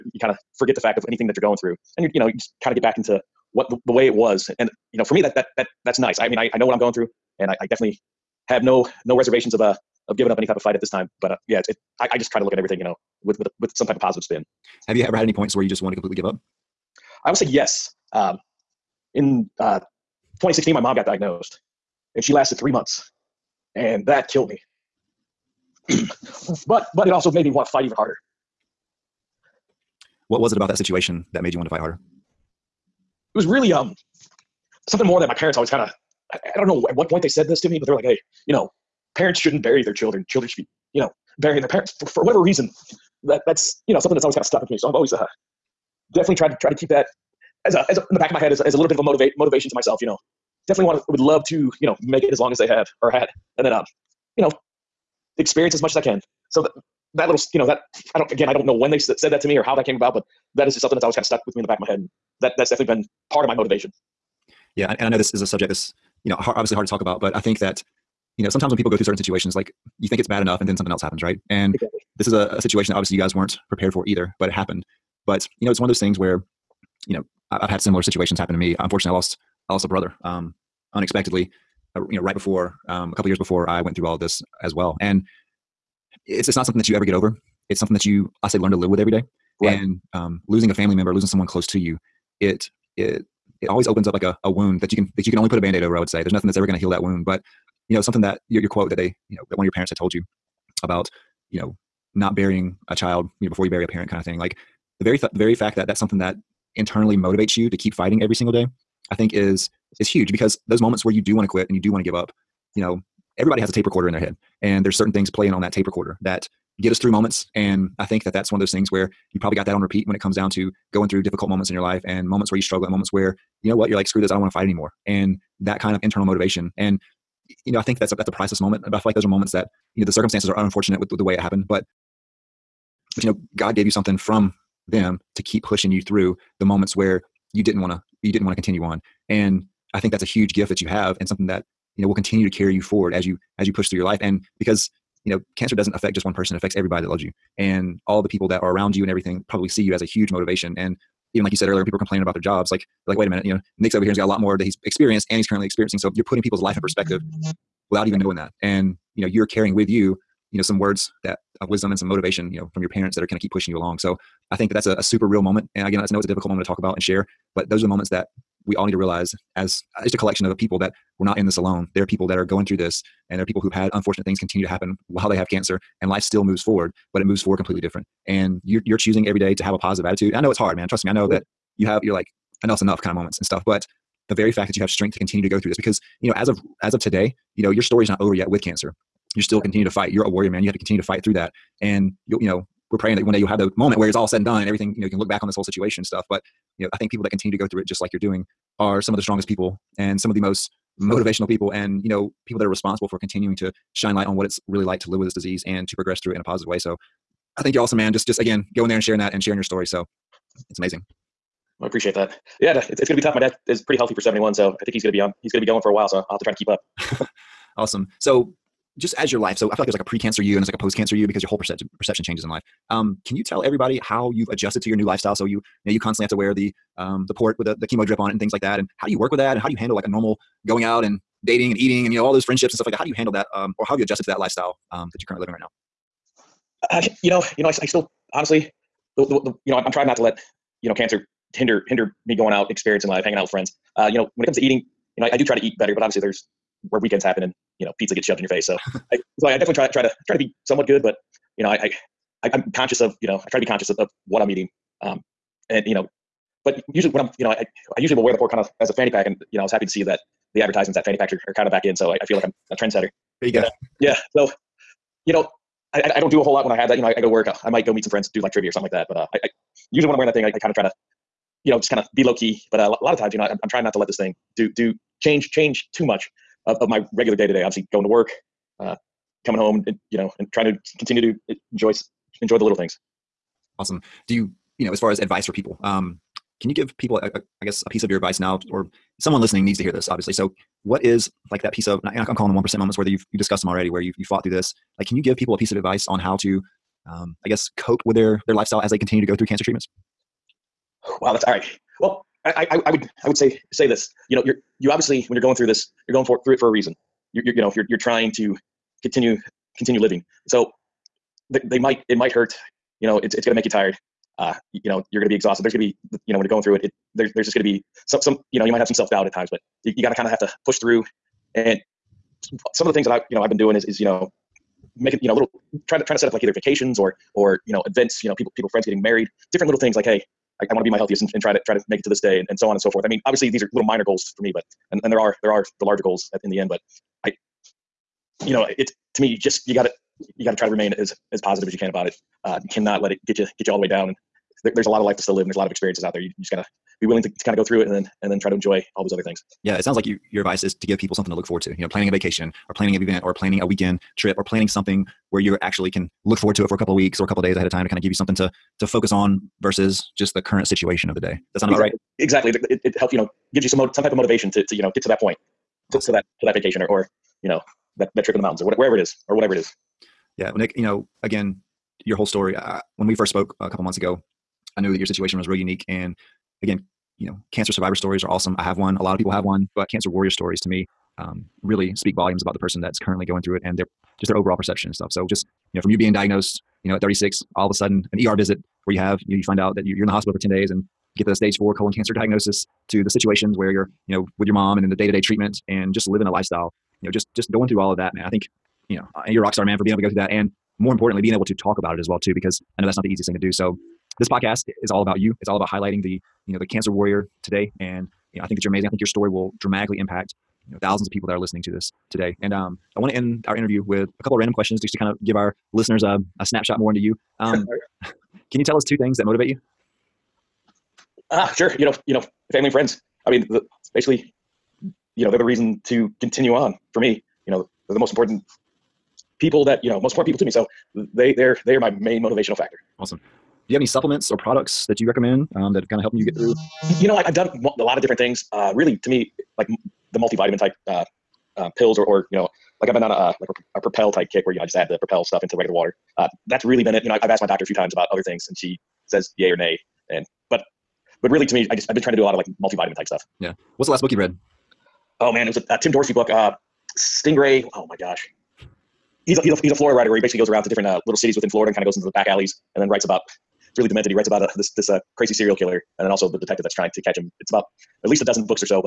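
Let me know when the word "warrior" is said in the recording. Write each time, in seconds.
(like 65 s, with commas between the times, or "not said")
190 s, 380 s, 406 s.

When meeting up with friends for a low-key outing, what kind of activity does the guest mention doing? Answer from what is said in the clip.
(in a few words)
Trivia.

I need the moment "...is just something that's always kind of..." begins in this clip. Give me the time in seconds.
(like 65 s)
60 s.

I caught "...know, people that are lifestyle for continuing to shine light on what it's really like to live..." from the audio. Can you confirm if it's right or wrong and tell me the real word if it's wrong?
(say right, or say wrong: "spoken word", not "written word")
wrong: "responsible", not "lifestyle".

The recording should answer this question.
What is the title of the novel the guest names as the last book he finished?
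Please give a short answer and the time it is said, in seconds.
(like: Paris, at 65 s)
Stingray, at 456 s.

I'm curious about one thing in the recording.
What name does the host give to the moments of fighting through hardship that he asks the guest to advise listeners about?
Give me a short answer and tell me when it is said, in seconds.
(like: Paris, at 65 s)
One percent moments, at 292 s.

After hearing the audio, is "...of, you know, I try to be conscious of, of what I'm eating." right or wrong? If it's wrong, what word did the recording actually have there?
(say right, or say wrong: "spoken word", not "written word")
right.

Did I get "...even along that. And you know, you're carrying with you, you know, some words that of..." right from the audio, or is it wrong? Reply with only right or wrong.
wrong.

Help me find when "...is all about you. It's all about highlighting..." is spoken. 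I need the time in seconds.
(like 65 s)
404 s.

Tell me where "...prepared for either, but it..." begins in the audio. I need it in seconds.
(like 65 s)
73 s.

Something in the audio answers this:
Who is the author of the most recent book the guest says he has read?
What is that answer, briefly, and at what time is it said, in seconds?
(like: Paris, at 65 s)
Tim Dorsey, at 455 s.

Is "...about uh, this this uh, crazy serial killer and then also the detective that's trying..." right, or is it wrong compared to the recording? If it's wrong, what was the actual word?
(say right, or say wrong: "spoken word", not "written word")
right.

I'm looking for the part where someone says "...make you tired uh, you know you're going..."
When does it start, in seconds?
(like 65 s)
313 s.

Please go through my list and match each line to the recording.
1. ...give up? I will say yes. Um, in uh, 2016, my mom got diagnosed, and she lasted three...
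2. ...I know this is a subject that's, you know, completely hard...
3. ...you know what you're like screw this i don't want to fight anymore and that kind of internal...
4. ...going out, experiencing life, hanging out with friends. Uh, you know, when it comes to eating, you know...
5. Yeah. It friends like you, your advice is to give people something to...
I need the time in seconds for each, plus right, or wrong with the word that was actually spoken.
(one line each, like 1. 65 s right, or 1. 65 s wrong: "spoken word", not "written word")
1. 16 s right
2. 65 s wrong: "obviously", not "completely"
3. 123 s right
4. 242 s right
5. 349 s wrong: "sounds", not "friends".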